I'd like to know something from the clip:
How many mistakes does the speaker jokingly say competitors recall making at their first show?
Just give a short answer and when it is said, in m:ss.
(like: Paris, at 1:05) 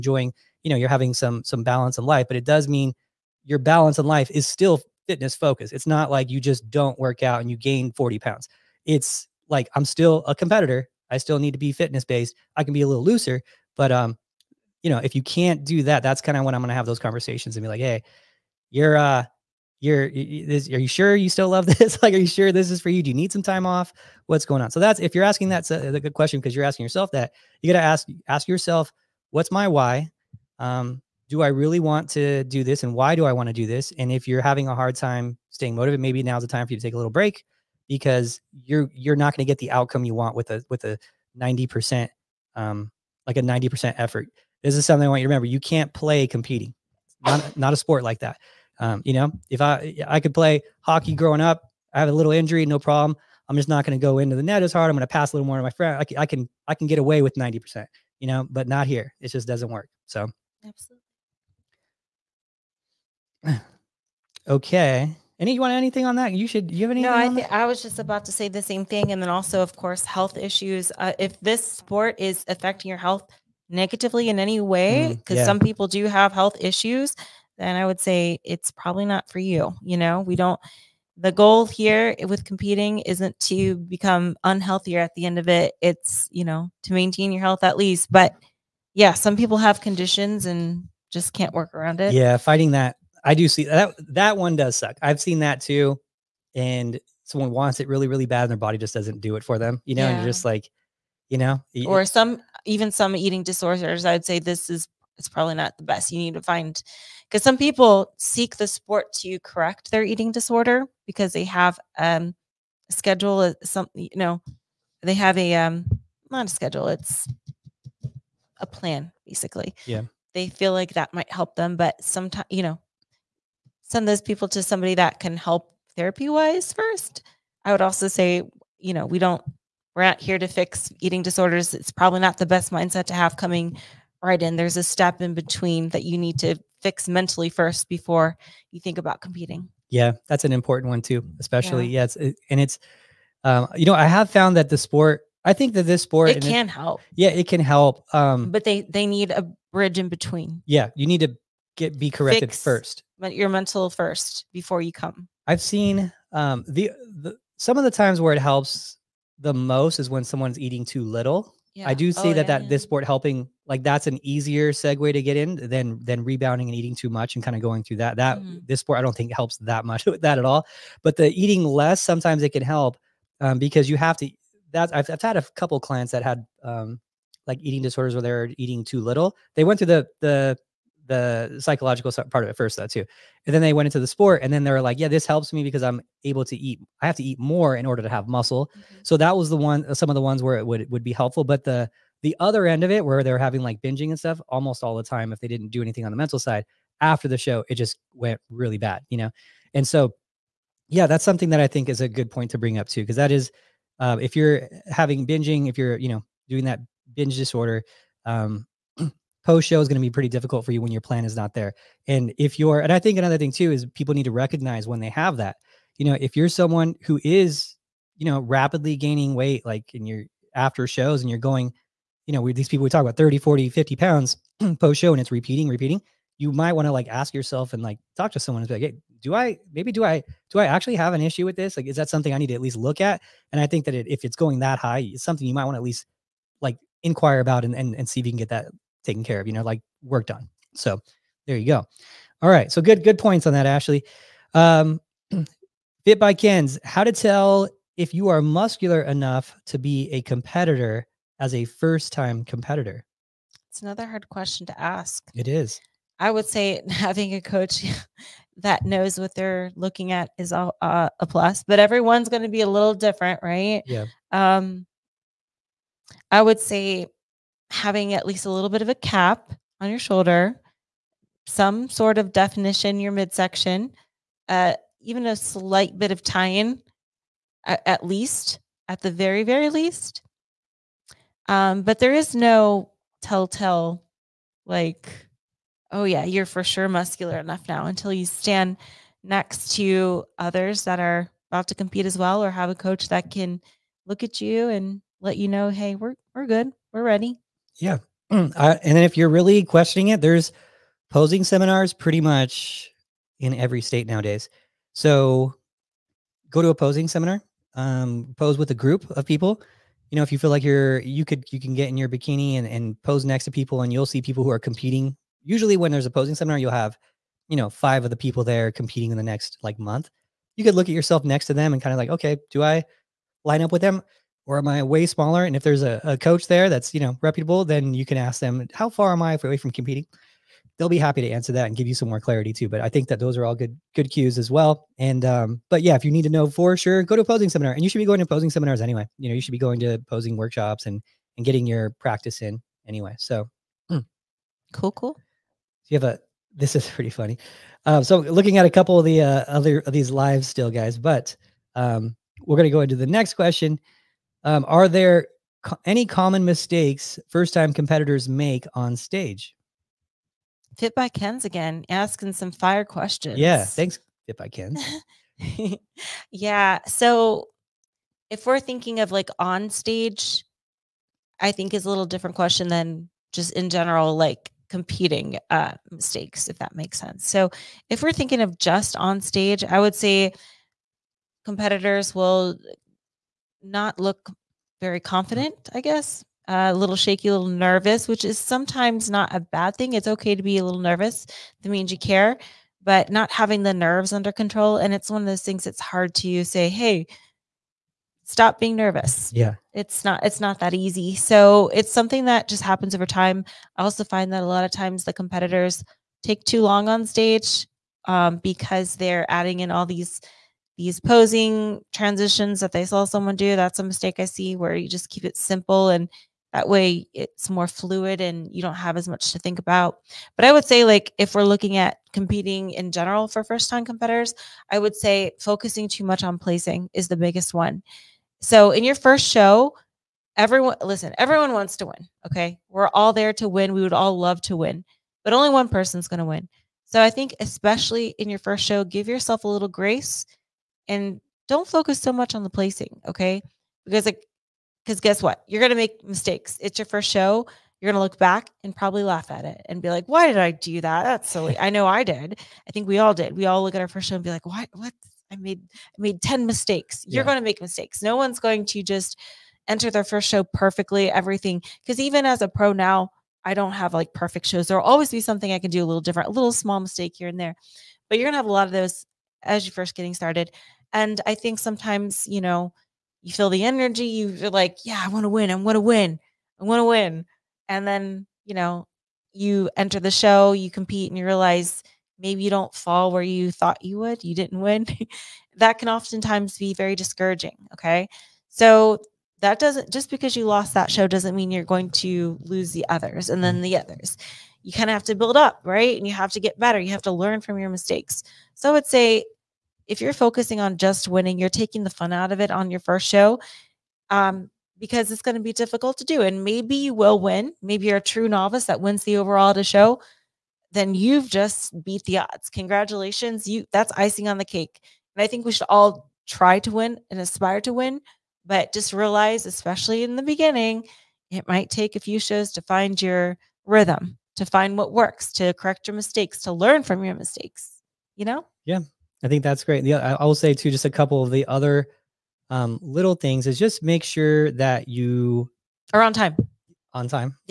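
10, at 7:36.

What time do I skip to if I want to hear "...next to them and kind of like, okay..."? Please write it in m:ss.
5:21.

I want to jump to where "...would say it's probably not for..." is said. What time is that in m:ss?
1:17.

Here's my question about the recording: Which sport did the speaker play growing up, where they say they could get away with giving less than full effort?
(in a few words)
Hockey.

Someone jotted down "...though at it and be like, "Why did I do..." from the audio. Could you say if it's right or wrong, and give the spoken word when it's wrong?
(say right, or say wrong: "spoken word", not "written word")
wrong: "laugh", not "though".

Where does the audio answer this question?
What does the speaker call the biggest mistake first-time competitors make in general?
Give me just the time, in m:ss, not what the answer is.
7:05.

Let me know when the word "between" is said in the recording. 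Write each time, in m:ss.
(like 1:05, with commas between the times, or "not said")
2:15, 2:30.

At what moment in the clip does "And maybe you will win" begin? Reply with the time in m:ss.
8:26.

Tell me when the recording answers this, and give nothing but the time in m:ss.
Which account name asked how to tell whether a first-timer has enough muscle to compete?
4:06.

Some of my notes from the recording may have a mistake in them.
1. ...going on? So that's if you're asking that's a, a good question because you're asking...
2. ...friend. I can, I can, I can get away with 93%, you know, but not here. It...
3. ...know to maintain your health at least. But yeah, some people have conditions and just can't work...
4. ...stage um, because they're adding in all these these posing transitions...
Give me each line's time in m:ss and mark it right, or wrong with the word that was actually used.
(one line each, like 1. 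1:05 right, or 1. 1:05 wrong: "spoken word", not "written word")
1. 0:24 right
2. 0:55 wrong: "90", not "93"
3. 1:26 right
4. 6:47 right.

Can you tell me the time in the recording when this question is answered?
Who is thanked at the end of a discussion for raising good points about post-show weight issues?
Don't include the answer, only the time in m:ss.
4:03.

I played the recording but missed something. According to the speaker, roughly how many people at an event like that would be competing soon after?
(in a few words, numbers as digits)
5.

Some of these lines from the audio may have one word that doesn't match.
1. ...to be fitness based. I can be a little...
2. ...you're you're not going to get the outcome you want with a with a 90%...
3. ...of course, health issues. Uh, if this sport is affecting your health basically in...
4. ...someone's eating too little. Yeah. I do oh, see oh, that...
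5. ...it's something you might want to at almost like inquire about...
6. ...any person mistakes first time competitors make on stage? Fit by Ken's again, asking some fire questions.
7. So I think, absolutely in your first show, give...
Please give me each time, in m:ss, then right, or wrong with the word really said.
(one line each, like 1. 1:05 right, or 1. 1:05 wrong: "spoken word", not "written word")
1. 0:11 right
2. 0:38 right
3. 1:09 wrong: "negatively", not "basically"
4. 2:40 right
5. 3:55 wrong: "least", not "almost"
6. 5:55 wrong: "common", not "person"
7. 7:16 wrong: "especially", not "absolutely".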